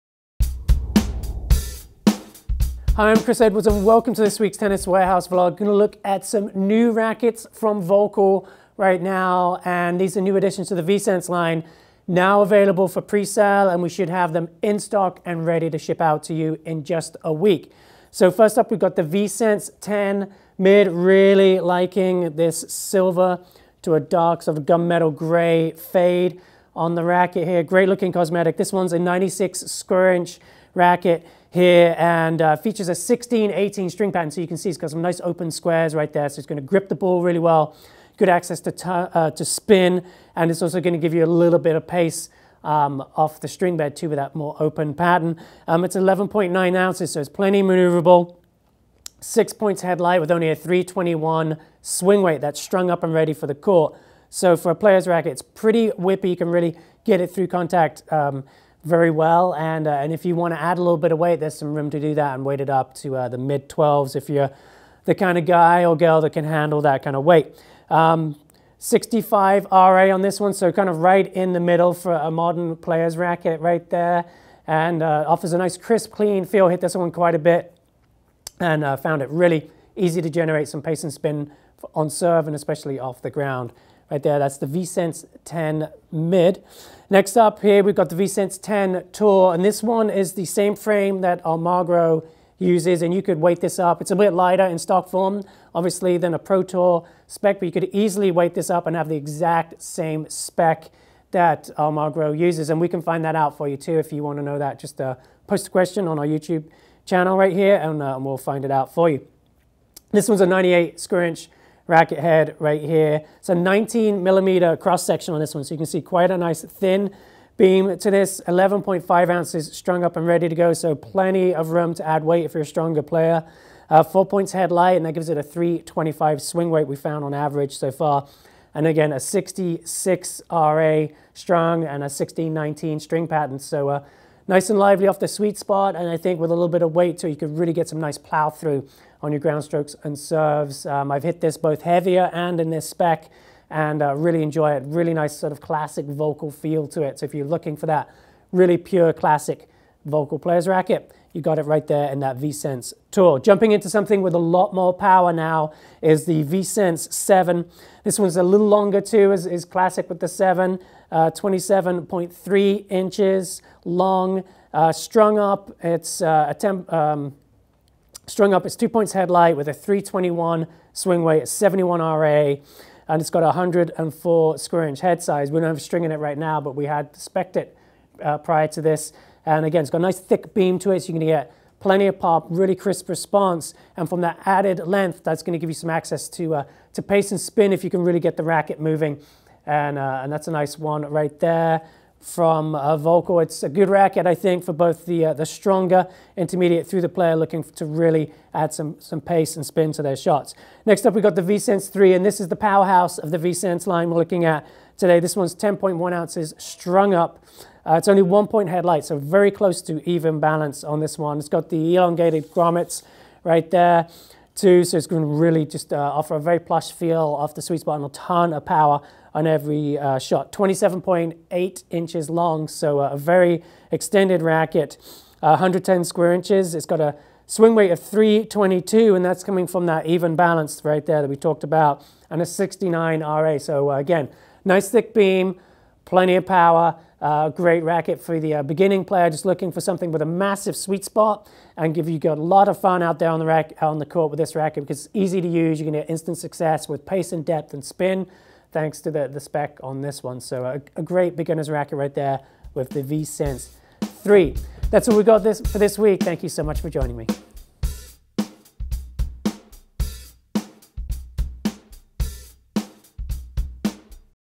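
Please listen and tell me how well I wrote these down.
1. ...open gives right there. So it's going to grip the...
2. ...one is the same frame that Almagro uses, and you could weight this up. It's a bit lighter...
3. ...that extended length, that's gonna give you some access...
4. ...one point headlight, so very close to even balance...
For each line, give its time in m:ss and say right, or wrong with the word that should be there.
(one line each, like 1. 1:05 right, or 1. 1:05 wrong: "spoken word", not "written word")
1. 0:35 wrong: "squares", not "gives"
2. 1:29 right
3. 3:04 wrong: "added", not "extended"
4. 3:28 right.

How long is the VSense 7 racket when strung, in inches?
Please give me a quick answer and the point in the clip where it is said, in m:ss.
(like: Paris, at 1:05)
27.3 inches, at 2:41.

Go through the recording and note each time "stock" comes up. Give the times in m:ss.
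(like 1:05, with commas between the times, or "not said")
0:14, 1:34.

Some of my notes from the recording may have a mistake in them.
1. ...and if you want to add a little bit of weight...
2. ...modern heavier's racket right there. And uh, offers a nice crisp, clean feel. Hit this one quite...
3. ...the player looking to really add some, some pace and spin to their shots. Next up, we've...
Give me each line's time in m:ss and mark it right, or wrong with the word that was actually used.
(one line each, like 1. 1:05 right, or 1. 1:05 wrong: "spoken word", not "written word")
1. 0:59 right
2. 1:12 wrong: "player", not "heavier"
3. 3:17 right.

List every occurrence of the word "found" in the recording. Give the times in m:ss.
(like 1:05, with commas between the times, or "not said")
1:18, 2:06.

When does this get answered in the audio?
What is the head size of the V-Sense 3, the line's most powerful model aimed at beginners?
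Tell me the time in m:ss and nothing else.
3:45.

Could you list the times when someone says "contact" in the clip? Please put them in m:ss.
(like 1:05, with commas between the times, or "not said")
0:57.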